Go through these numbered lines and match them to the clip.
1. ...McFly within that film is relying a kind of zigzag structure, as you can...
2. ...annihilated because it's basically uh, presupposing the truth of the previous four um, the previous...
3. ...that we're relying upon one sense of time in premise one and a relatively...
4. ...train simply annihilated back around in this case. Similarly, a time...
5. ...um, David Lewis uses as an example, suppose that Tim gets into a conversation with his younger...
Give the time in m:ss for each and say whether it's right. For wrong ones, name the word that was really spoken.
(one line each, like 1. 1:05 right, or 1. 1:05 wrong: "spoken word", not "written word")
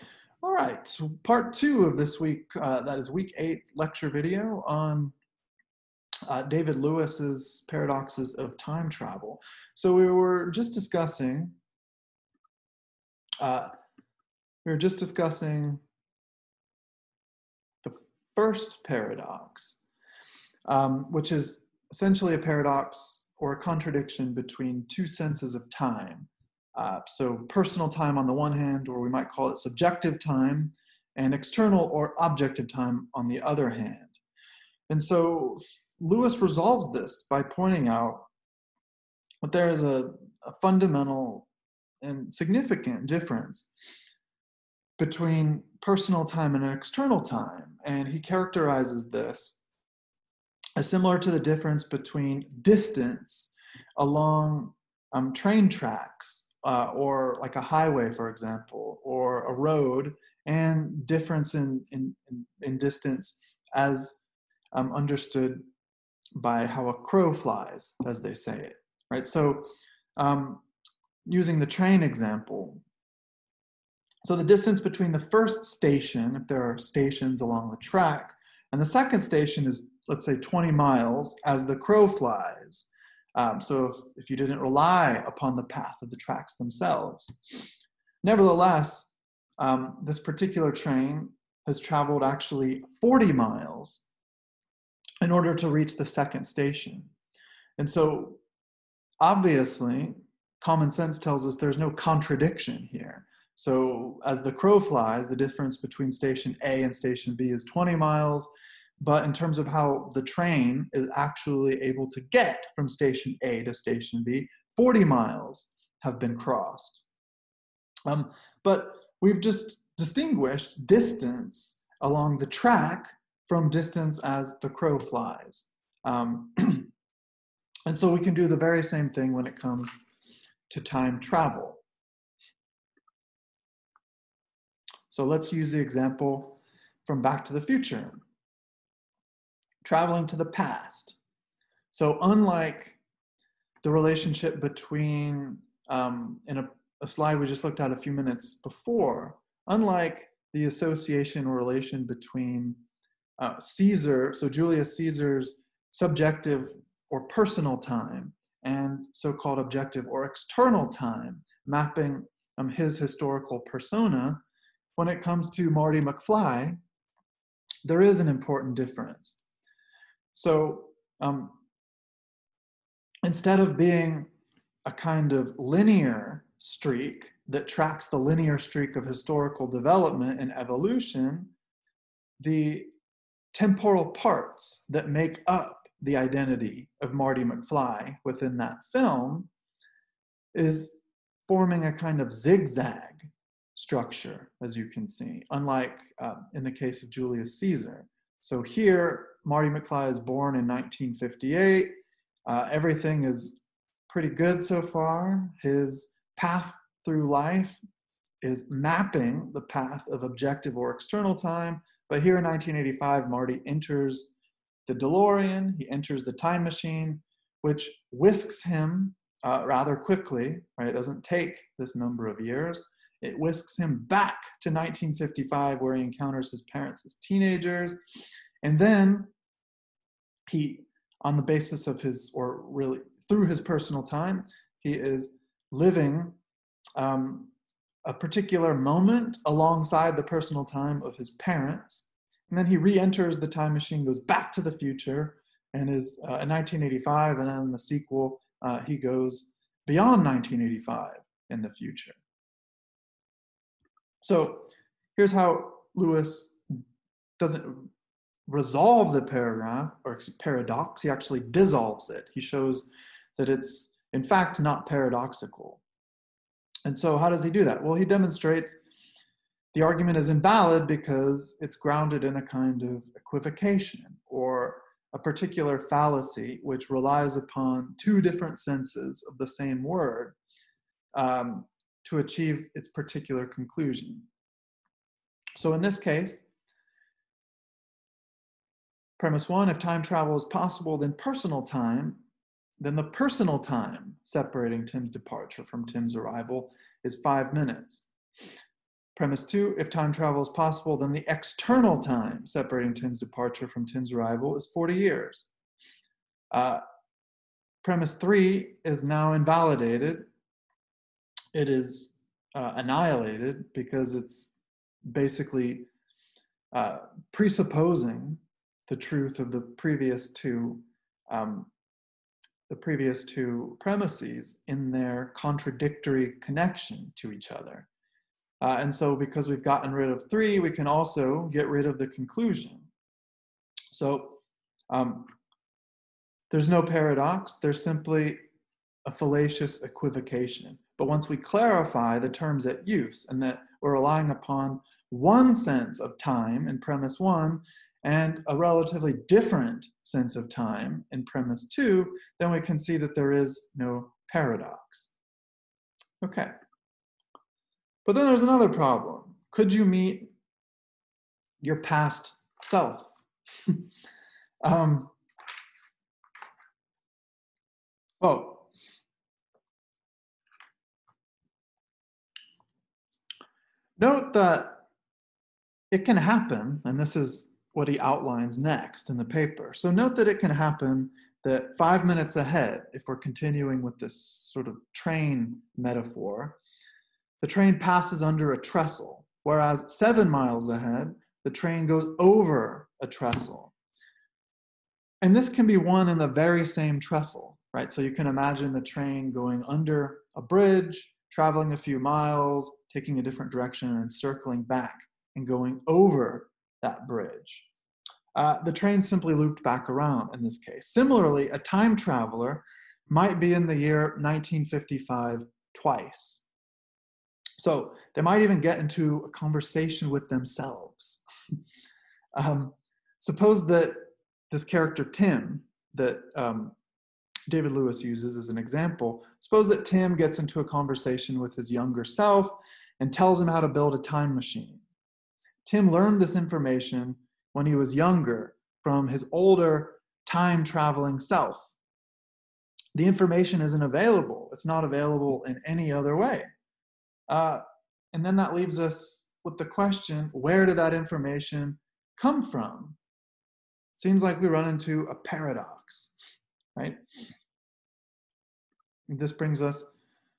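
1. 3:07 wrong: "forming", not "relying"
2. 5:12 wrong: "two", not "four"
3. 5:43 right
4. 6:48 wrong: "looped", not "annihilated"
5. 7:06 right.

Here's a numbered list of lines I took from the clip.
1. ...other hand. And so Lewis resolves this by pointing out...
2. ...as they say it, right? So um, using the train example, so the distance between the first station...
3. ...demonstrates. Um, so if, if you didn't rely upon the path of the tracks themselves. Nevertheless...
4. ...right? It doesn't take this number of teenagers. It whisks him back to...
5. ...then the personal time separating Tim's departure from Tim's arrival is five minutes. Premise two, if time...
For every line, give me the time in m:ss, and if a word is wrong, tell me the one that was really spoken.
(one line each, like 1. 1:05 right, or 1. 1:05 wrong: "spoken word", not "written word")
1. 0:33 right
2. 1:08 right
3. 1:22 wrong: "flies", not "demonstrates"
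4. 3:40 wrong: "years", not "teenagers"
5. 4:52 right.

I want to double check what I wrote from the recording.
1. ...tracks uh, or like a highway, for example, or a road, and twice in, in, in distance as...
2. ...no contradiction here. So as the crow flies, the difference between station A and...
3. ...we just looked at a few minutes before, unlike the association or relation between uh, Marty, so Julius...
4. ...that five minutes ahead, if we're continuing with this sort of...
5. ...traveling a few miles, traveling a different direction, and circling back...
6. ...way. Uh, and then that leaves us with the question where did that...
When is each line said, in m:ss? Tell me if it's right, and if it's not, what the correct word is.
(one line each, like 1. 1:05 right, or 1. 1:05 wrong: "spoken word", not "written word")
1. 0:55 wrong: "difference", not "twice"
2. 1:41 right
3. 2:27 wrong: "Caesar", not "Marty"
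4. 6:21 right
5. 6:41 wrong: "taking", not "traveling"
6. 7:26 right.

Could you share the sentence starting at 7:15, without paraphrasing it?
Tim learned this information when he was younger from his older time traveling self.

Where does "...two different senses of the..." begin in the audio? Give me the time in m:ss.
4:37.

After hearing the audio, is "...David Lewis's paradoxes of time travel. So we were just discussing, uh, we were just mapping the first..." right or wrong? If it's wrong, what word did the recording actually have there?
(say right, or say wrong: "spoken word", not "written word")
wrong: "discussing", not "mapping".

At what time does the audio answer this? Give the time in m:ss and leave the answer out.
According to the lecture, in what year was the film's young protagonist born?
3:20.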